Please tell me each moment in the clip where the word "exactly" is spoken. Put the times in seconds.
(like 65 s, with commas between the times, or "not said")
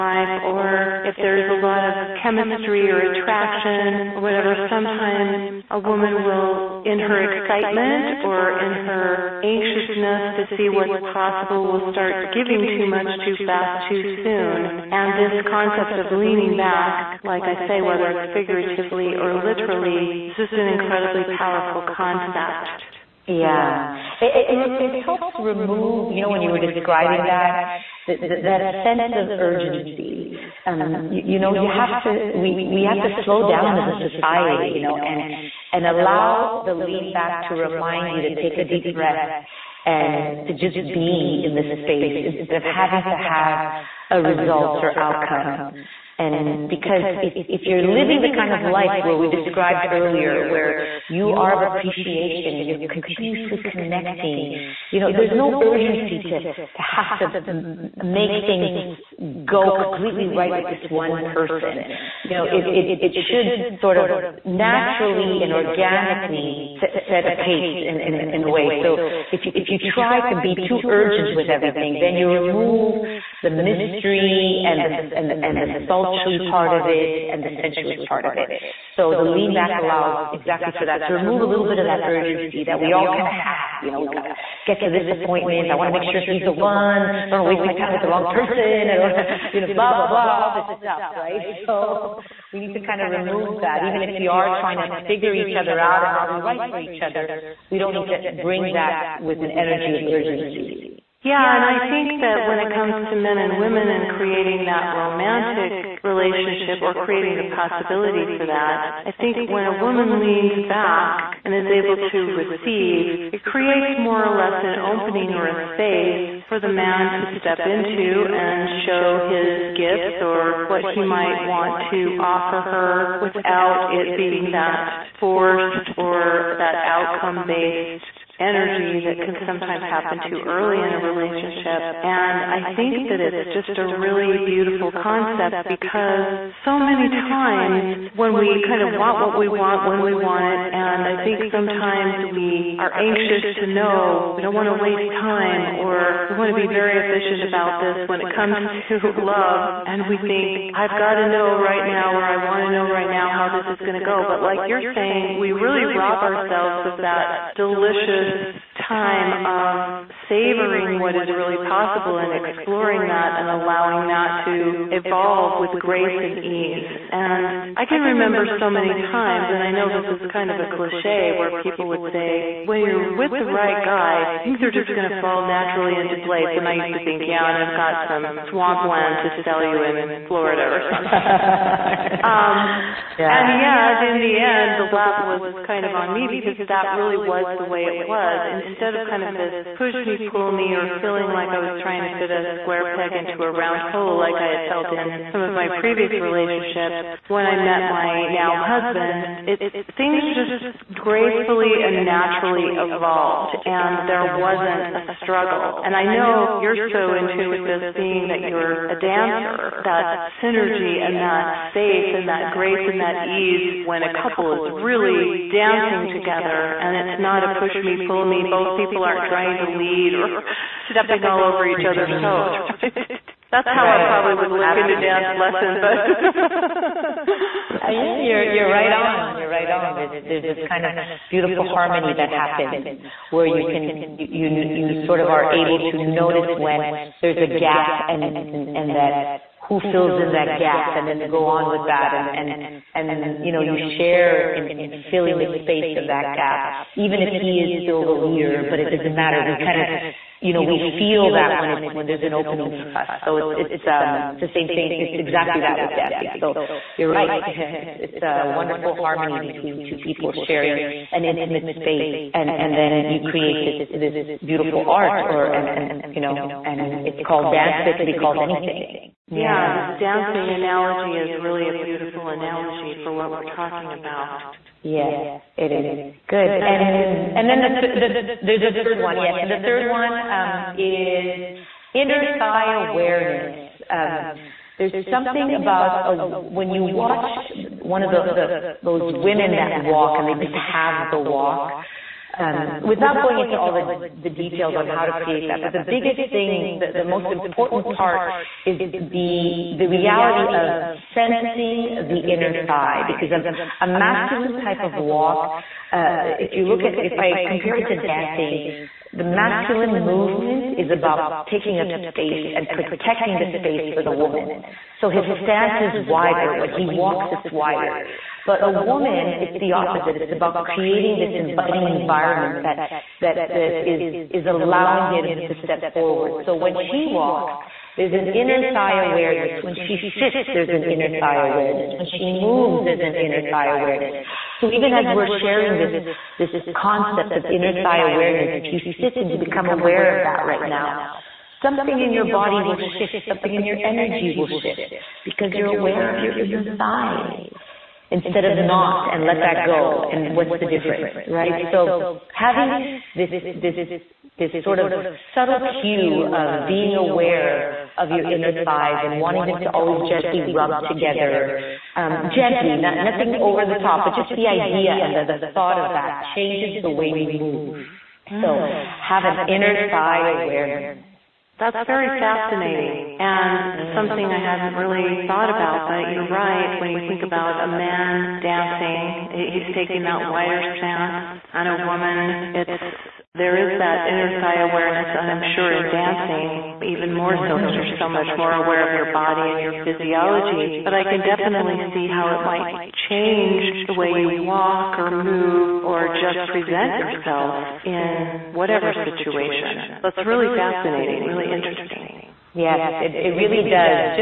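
80 s, 255 s.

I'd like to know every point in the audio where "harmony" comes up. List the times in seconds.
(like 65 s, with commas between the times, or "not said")
231 s, 258 s.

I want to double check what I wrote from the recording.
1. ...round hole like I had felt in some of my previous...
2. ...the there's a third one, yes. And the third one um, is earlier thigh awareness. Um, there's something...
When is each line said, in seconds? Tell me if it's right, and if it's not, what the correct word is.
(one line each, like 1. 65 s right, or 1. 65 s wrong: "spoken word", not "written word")
1. 193 s right
2. 277 s wrong: "inner", not "earlier".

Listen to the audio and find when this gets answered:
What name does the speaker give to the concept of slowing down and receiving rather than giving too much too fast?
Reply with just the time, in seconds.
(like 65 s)
16 s.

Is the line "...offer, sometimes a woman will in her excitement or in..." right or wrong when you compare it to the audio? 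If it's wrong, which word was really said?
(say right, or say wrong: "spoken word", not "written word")
wrong: "whatever", not "offer".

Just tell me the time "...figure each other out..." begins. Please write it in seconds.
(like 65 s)
95 s.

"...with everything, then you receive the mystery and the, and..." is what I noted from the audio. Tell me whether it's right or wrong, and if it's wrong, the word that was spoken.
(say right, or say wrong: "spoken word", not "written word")
wrong: "remove", not "receive".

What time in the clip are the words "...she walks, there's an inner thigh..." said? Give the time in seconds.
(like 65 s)
326 s.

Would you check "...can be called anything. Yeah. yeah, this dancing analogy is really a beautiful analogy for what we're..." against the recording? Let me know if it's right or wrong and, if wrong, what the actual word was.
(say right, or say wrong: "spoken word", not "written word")
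right.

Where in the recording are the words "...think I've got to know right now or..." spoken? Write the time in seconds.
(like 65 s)
150 s.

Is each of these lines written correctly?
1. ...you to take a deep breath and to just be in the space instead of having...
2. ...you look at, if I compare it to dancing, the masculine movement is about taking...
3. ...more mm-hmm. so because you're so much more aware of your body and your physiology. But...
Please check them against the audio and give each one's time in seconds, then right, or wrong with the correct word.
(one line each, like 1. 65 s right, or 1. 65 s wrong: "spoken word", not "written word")
1. 38 s right
2. 306 s right
3. 387 s right.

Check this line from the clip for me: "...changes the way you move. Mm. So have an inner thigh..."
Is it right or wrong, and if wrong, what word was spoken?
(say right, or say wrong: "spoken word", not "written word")
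right.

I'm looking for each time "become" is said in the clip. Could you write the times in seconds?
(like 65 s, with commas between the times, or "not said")
339 s.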